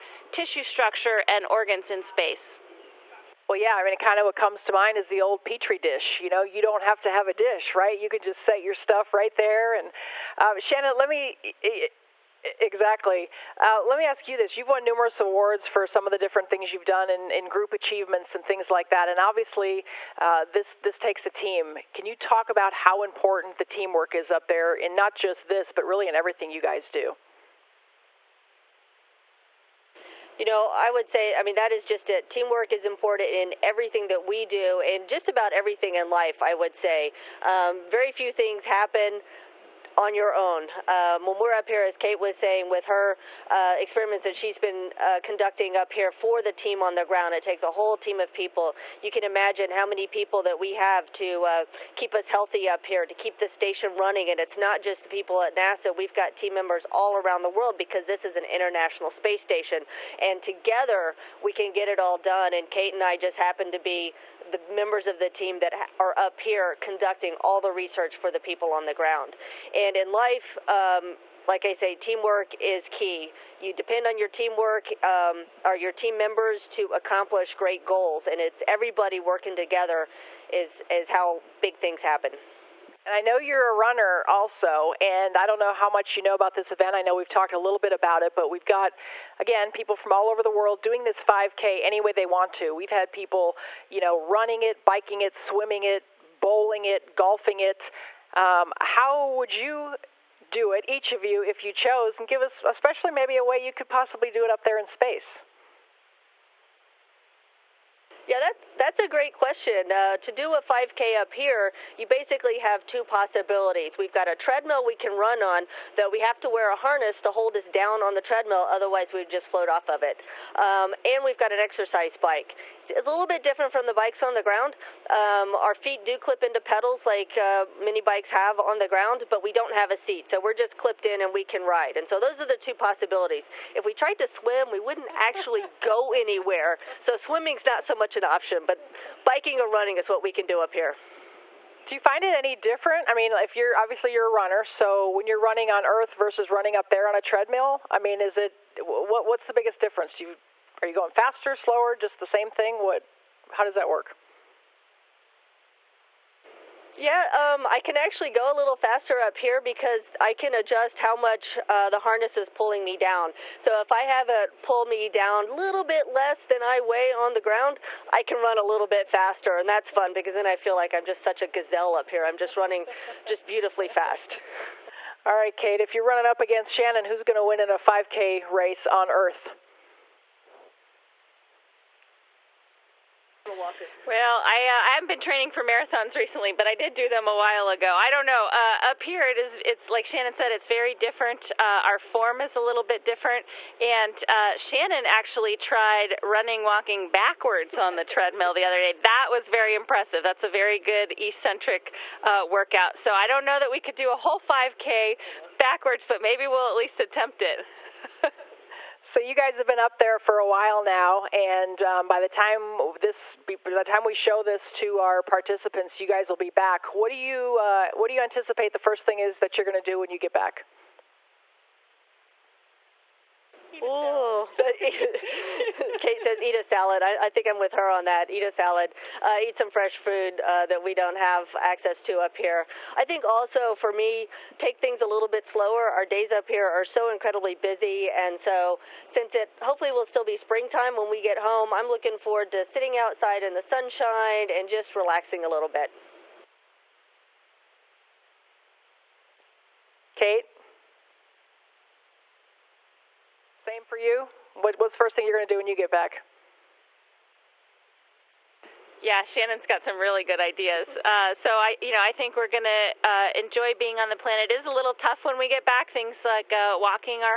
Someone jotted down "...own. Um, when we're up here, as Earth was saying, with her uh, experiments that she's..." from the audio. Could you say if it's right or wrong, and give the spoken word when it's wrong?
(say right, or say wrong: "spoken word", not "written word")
wrong: "Kate", not "Earth".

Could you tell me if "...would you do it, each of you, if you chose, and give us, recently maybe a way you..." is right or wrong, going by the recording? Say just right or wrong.
wrong.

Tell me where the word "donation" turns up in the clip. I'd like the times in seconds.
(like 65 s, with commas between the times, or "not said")
not said.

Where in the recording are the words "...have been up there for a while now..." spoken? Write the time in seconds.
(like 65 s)
209 s.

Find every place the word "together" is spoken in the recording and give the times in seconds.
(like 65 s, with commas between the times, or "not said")
60 s, 79 s.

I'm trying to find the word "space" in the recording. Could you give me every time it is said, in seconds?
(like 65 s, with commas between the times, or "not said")
2 s, 59 s, 104 s.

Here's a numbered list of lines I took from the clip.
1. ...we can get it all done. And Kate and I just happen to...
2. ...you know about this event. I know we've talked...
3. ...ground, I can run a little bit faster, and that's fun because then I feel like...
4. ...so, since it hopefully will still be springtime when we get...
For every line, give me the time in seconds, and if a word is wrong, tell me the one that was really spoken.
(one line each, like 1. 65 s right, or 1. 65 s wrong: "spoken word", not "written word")
1. 61 s right
2. 86 s right
3. 167 s right
4. 238 s right.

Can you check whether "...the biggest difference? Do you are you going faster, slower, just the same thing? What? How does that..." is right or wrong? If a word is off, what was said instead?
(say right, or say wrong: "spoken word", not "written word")
right.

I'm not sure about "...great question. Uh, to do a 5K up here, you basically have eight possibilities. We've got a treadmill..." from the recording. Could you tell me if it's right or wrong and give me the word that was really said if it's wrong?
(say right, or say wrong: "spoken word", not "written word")
wrong: "two", not "eight".